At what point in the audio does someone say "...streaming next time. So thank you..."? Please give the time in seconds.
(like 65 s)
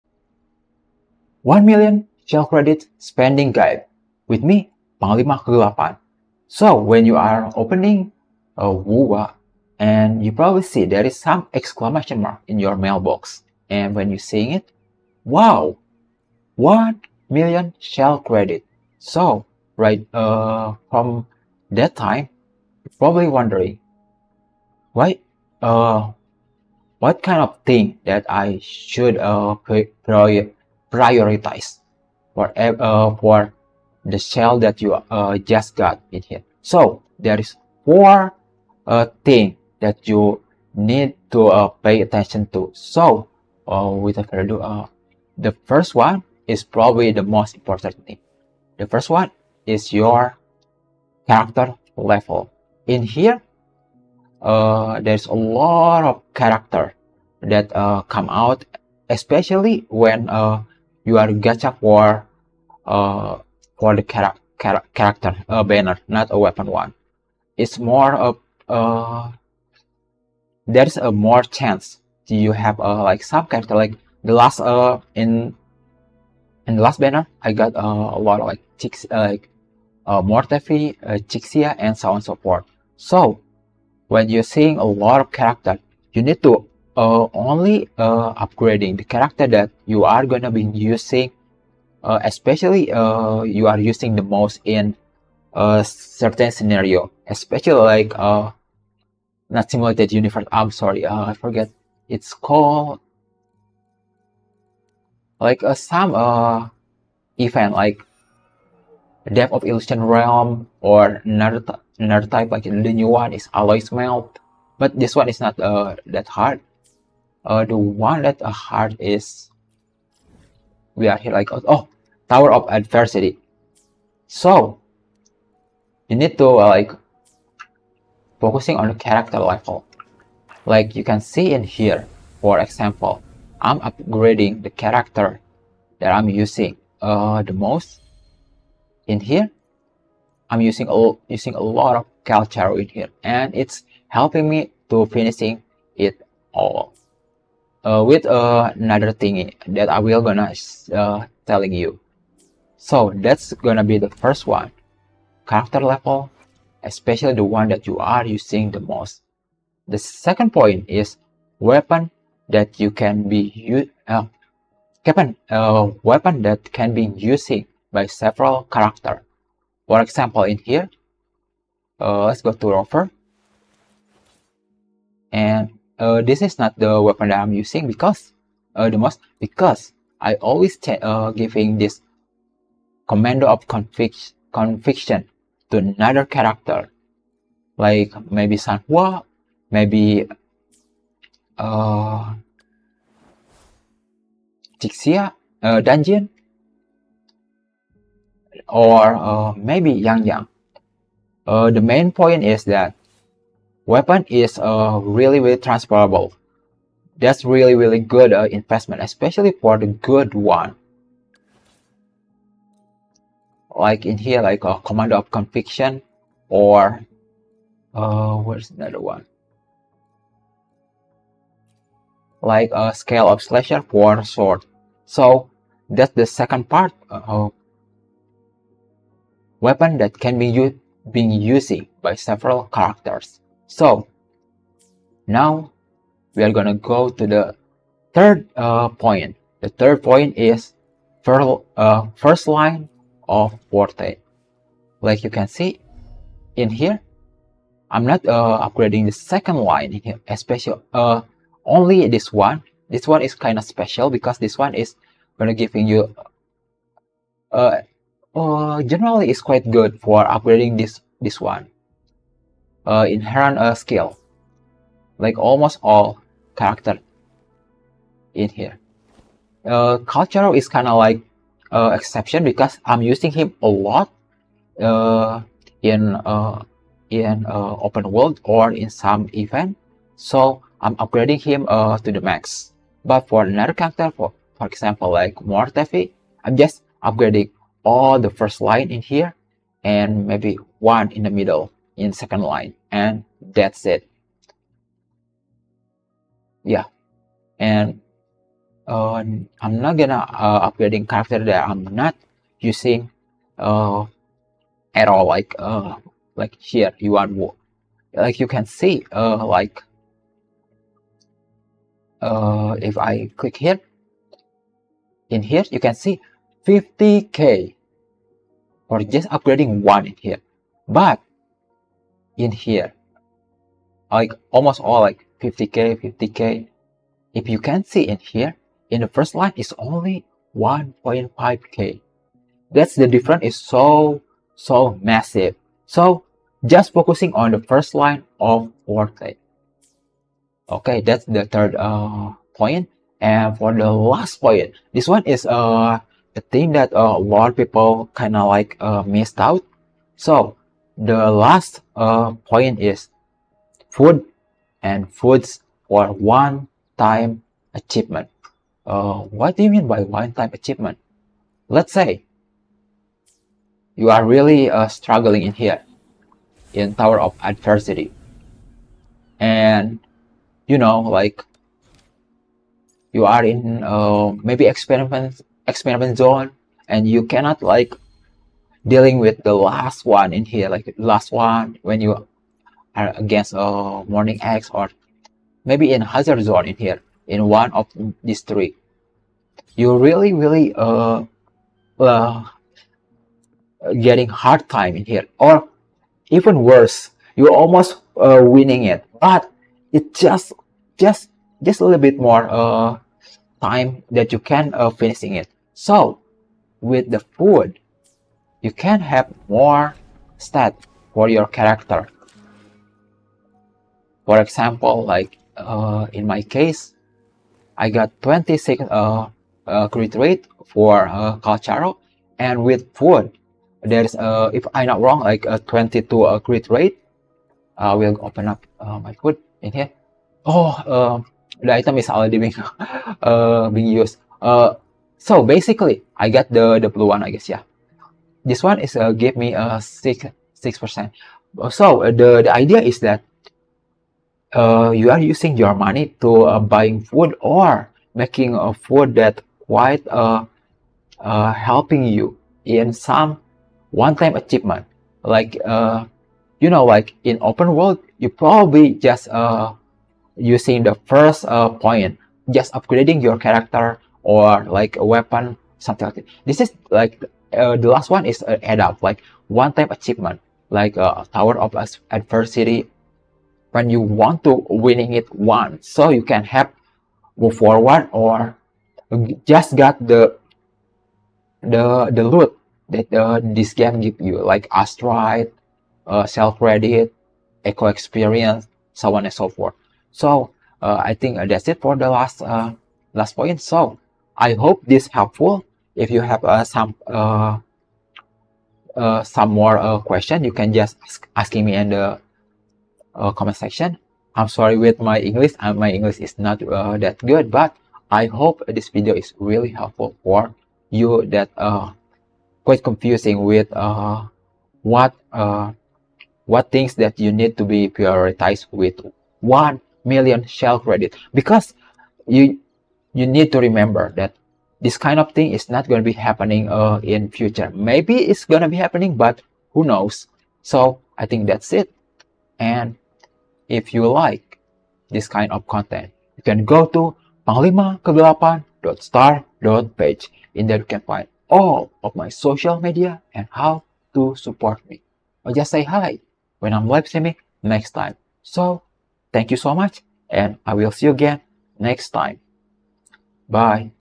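547 s.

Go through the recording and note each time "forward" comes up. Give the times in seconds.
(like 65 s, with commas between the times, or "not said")
477 s.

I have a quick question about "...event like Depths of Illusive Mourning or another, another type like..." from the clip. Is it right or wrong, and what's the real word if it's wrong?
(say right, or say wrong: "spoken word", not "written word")
wrong: "Realm", not "Mourning".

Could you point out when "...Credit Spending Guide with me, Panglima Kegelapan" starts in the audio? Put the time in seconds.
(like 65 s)
2 s.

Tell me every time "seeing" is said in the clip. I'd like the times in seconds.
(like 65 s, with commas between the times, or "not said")
14 s, 84 s.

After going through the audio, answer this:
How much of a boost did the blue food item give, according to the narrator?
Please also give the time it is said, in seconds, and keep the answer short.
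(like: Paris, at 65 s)
6 percent, at 440 s.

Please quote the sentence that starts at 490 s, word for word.
So uh, I think uh, that's it for the last last point.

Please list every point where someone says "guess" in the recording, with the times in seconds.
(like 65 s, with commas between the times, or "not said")
437 s.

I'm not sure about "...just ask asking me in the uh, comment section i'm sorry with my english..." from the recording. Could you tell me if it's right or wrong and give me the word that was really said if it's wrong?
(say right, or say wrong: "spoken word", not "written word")
right.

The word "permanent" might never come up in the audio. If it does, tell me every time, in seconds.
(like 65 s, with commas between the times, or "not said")
not said.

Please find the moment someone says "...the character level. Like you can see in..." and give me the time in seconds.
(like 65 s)
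128 s.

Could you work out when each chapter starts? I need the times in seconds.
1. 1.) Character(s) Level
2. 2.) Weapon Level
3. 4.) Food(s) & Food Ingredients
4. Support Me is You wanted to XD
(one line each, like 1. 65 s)
1. 44 s
2. 160 s
3. 343 s
4. 492 s.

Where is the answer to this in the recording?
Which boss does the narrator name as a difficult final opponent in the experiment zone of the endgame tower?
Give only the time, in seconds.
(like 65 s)
384 s.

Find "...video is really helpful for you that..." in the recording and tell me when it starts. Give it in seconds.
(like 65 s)
508 s.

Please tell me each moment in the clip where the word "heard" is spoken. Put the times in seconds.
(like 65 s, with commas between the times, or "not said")
118 s.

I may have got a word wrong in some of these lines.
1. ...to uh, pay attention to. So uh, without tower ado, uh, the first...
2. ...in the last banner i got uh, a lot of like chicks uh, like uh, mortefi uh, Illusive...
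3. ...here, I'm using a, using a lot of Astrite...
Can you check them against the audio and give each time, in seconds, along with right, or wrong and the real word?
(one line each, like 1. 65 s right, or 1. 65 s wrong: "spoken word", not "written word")
1. 41 s wrong: "further", not "tower"
2. 76 s wrong: "Chixia", not "Illusive"
3. 139 s wrong: "Calcharo", not "Astrite".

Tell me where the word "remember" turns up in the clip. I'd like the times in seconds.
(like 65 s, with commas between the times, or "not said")
523 s.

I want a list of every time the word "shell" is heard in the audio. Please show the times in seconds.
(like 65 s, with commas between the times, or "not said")
2 s, 17 s, 34 s, 486 s, 520 s.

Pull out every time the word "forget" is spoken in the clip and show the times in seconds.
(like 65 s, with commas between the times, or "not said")
101 s.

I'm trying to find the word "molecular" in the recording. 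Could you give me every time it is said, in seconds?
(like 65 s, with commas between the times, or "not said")
not said.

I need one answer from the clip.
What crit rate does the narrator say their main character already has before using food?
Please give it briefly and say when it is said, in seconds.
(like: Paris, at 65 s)
26, at 418 s.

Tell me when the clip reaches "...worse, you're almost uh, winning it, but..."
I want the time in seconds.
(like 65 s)
396 s.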